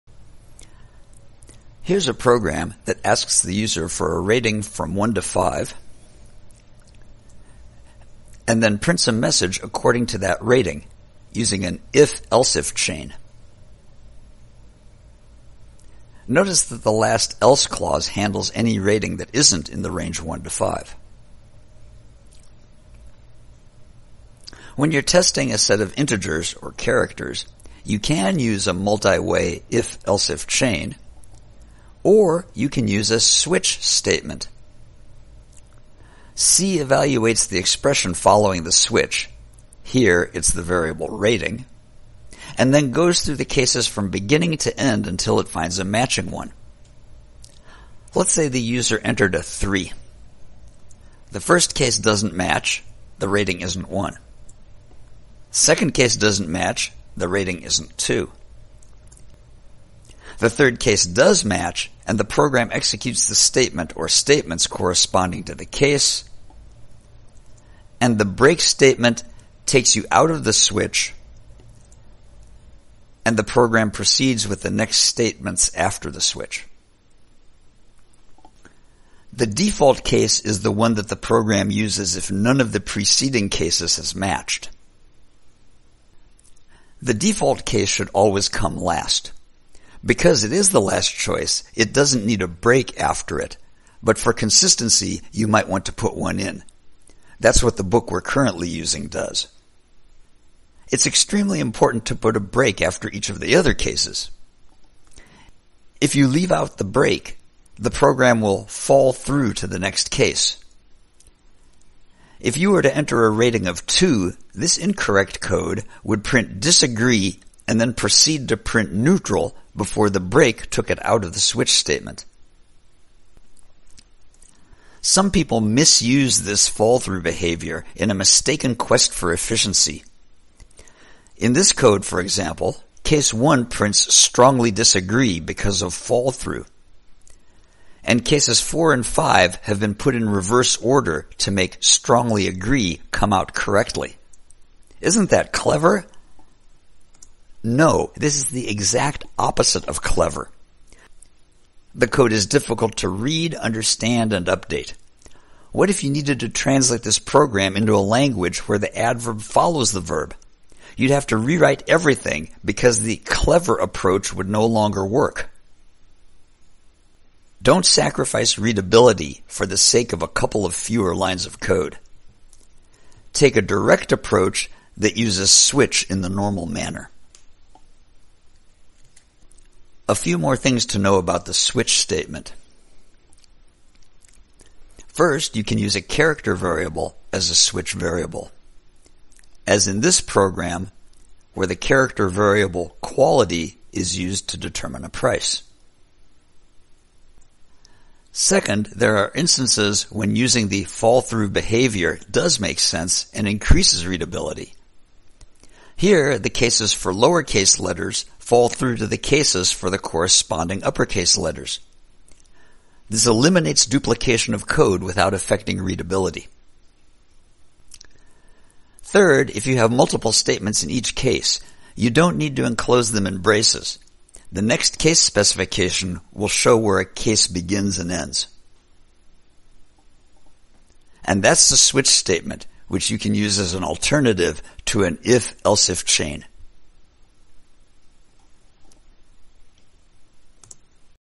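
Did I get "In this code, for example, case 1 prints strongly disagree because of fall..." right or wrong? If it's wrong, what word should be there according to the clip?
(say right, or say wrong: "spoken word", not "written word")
right.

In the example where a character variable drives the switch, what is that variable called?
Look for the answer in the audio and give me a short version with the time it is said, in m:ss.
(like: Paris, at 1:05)
quality, at 3:12.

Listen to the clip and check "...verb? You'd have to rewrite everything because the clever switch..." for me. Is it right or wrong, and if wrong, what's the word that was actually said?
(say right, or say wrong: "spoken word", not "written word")
wrong: "approach", not "switch".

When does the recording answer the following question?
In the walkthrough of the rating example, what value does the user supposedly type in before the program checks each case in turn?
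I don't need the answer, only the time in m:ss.
0:49.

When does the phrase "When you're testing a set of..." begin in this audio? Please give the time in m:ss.
0:24.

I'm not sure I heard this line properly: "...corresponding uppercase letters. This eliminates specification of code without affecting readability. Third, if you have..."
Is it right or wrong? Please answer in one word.
wrong.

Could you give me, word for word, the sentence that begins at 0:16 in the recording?
Notice that the last else clause handles any rating that isn't in the range 1 to 5.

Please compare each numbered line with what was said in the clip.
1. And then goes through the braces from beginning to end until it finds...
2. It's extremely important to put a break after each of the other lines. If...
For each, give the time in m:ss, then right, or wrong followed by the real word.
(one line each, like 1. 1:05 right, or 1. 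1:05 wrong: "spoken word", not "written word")
1. 0:42 wrong: "cases", not "braces"
2. 1:40 wrong: "cases", not "lines".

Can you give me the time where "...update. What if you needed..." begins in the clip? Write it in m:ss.
2:34.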